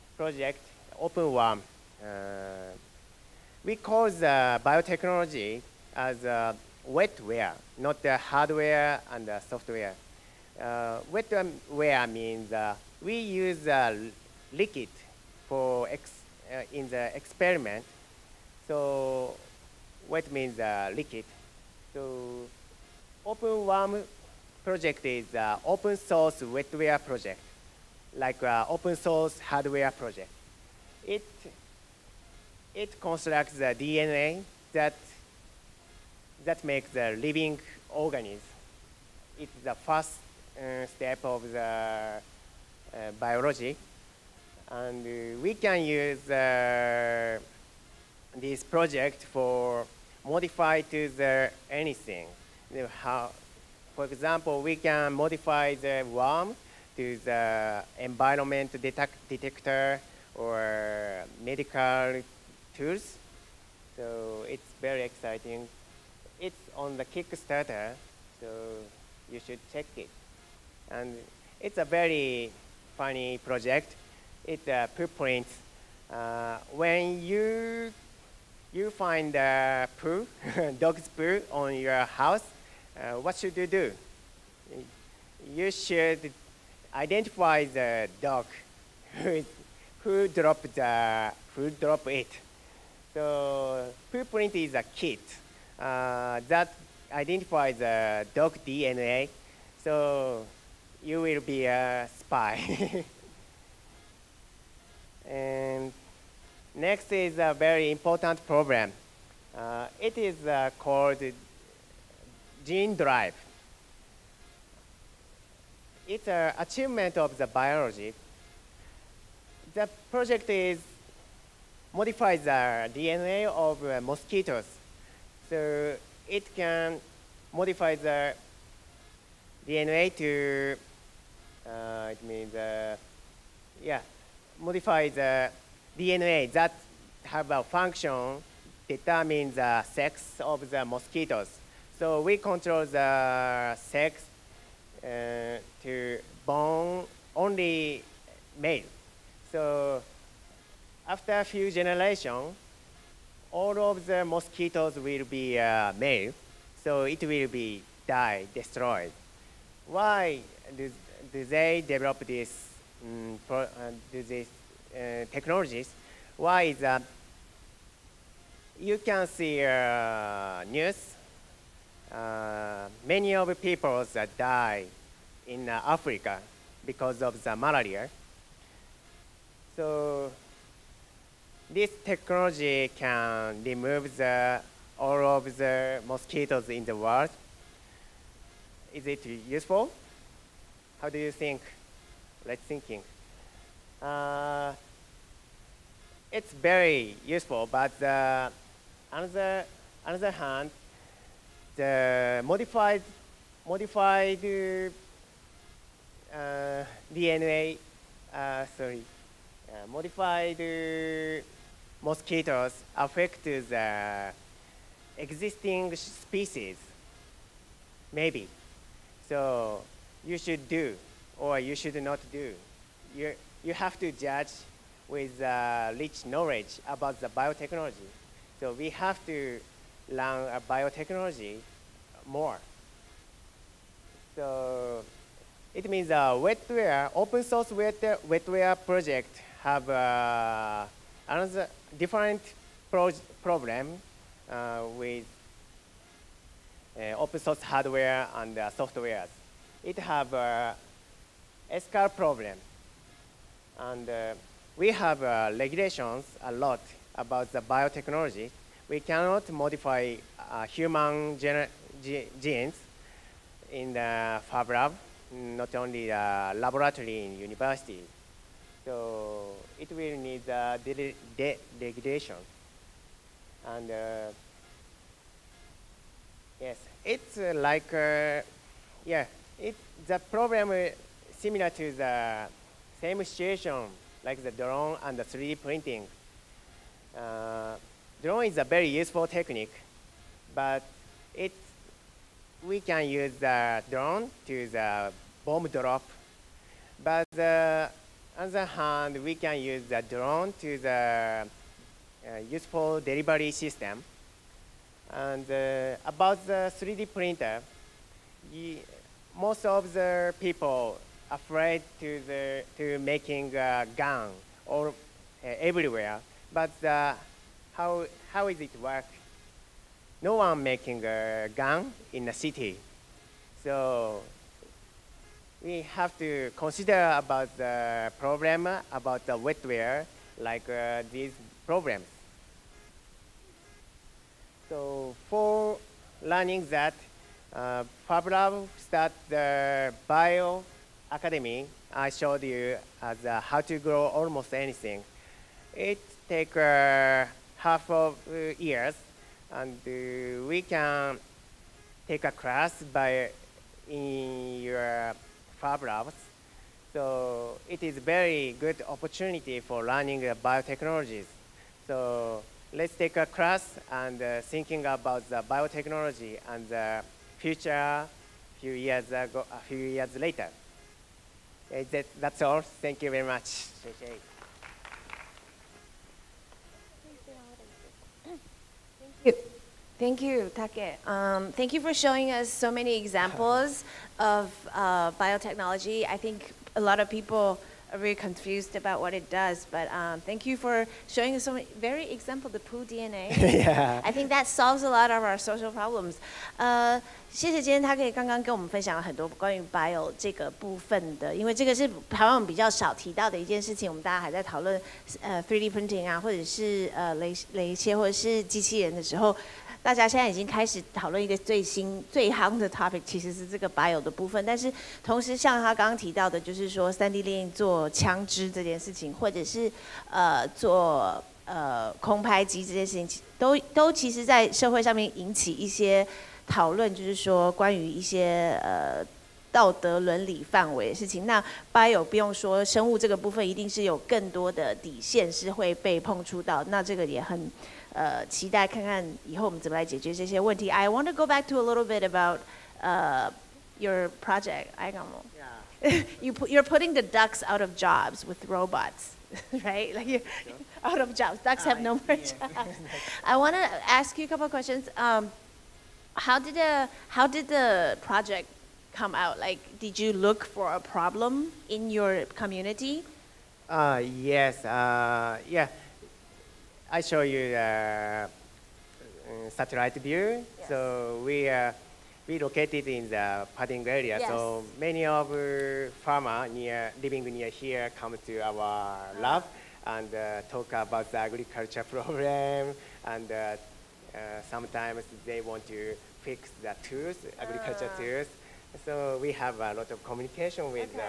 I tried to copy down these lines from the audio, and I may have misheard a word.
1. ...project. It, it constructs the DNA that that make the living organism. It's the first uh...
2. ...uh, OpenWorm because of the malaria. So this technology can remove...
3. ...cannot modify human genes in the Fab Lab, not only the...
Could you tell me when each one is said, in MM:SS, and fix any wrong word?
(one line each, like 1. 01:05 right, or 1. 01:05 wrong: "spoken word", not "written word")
1. 00:29 right
2. 02:55 wrong: "Africa", not "OpenWorm"
3. 04:18 right.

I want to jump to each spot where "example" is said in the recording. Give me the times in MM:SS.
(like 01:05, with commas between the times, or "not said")
00:54, 06:22, 06:32.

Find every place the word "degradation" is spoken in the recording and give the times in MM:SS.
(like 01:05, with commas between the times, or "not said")
04:31.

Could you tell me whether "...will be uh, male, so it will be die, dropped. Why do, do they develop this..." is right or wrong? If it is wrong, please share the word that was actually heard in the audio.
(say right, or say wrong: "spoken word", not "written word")
wrong: "destroyed", not "dropped".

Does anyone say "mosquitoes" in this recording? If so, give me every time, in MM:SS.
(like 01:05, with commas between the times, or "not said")
02:03, 02:20, 02:34, 03:06, 03:32.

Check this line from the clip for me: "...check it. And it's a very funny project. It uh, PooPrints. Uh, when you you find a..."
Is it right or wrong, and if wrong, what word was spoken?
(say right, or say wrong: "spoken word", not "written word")
right.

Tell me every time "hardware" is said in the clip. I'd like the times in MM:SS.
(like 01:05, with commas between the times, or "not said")
00:08, 00:29, 04:07.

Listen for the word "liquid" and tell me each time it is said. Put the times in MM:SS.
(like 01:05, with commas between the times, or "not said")
00:14, 00:20.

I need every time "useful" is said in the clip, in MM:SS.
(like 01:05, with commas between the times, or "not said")
03:09, 03:17, 04:48, 05:02.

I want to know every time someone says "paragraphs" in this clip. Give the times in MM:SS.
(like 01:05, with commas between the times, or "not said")
not said.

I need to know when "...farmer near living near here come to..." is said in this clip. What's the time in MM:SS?
07:56.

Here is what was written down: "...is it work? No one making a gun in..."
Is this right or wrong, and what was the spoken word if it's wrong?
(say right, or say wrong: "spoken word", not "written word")
right.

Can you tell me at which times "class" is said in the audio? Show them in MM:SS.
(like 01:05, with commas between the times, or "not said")
05:52, 06:03.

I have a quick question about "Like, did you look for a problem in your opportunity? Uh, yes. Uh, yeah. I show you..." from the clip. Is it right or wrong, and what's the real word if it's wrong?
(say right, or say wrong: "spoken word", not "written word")
wrong: "community", not "opportunity".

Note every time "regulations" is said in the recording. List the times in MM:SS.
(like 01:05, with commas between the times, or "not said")
04:15.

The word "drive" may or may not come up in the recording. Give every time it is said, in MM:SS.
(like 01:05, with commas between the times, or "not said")
01:52.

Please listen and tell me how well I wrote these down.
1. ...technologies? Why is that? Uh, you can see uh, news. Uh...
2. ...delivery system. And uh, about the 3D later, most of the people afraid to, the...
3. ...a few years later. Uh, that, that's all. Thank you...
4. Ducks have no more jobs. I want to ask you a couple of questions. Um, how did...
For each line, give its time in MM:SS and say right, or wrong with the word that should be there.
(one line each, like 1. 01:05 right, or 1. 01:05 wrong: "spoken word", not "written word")
1. 02:45 right
2. 05:02 wrong: "printer", not "later"
3. 06:09 right
4. 07:31 right.